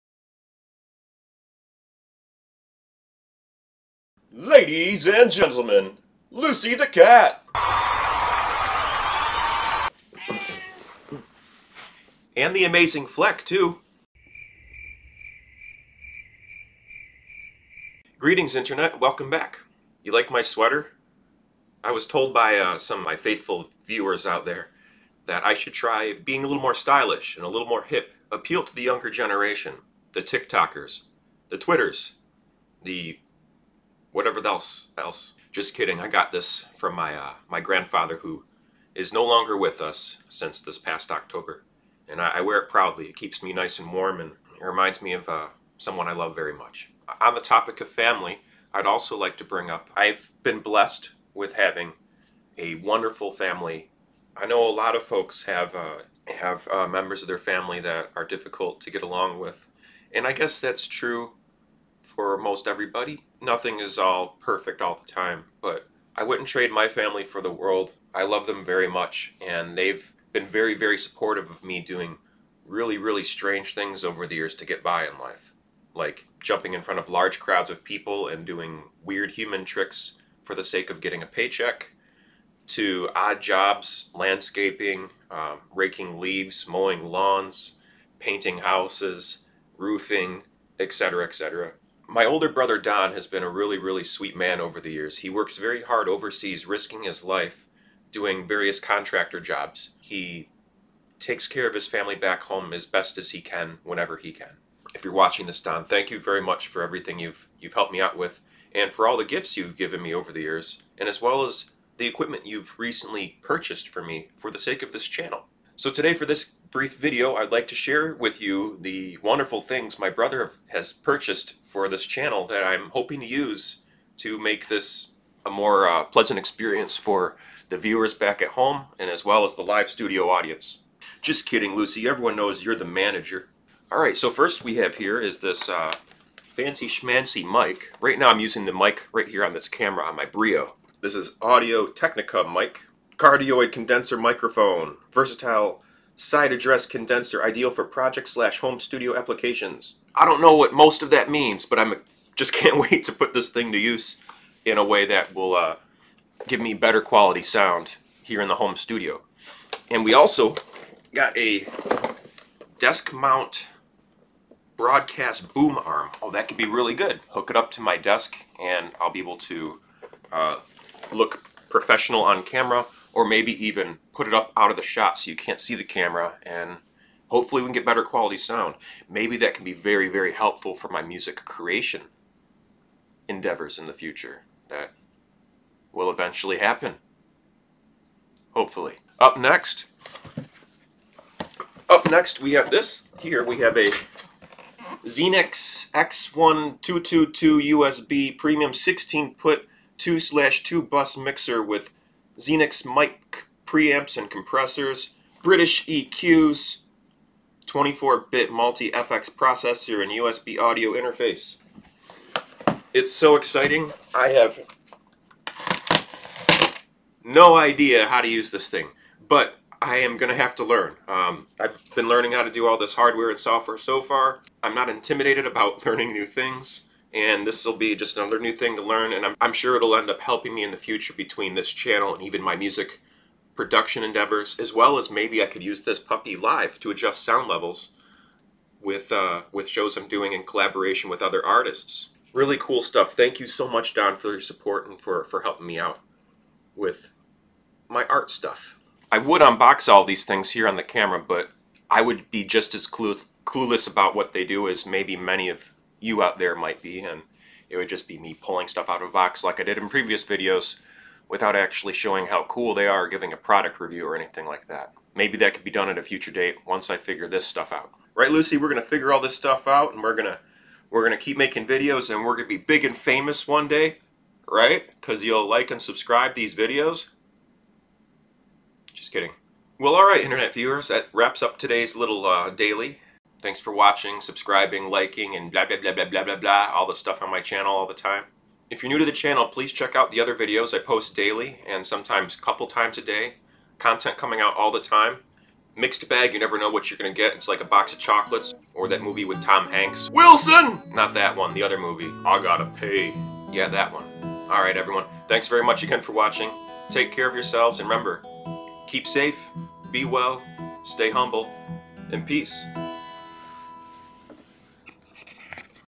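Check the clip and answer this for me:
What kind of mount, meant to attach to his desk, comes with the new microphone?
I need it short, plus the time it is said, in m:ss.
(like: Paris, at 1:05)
Broadcast boom arm, at 2:44.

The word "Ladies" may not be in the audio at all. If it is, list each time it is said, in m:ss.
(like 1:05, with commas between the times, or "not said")
0:04.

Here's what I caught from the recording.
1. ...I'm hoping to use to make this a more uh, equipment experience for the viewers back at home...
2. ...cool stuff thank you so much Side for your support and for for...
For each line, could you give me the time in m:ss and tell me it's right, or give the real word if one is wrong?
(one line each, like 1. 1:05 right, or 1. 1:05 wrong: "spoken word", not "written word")
1. 2:02 wrong: "pleasant", not "equipment"
2. 4:02 wrong: "Don", not "Side".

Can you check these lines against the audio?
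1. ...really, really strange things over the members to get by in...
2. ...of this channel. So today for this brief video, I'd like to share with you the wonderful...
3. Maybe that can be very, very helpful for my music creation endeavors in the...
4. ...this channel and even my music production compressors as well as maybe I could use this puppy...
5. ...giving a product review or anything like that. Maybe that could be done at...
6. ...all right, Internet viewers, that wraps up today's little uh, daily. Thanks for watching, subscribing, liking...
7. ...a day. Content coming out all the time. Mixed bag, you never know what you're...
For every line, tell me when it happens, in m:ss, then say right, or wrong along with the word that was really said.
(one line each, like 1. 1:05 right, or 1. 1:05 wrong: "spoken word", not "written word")
1. 1:12 wrong: "years", not "members"
2. 1:54 right
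3. 2:59 right
4. 3:51 wrong: "endeavors", not "compressors"
5. 4:23 right
6. 4:39 right
7. 4:52 right.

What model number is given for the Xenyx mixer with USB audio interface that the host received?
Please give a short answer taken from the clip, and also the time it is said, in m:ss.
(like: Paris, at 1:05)
X1222, at 3:15.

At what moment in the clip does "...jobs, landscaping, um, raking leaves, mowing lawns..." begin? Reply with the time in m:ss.
1:23.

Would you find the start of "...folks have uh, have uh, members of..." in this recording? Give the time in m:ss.
0:55.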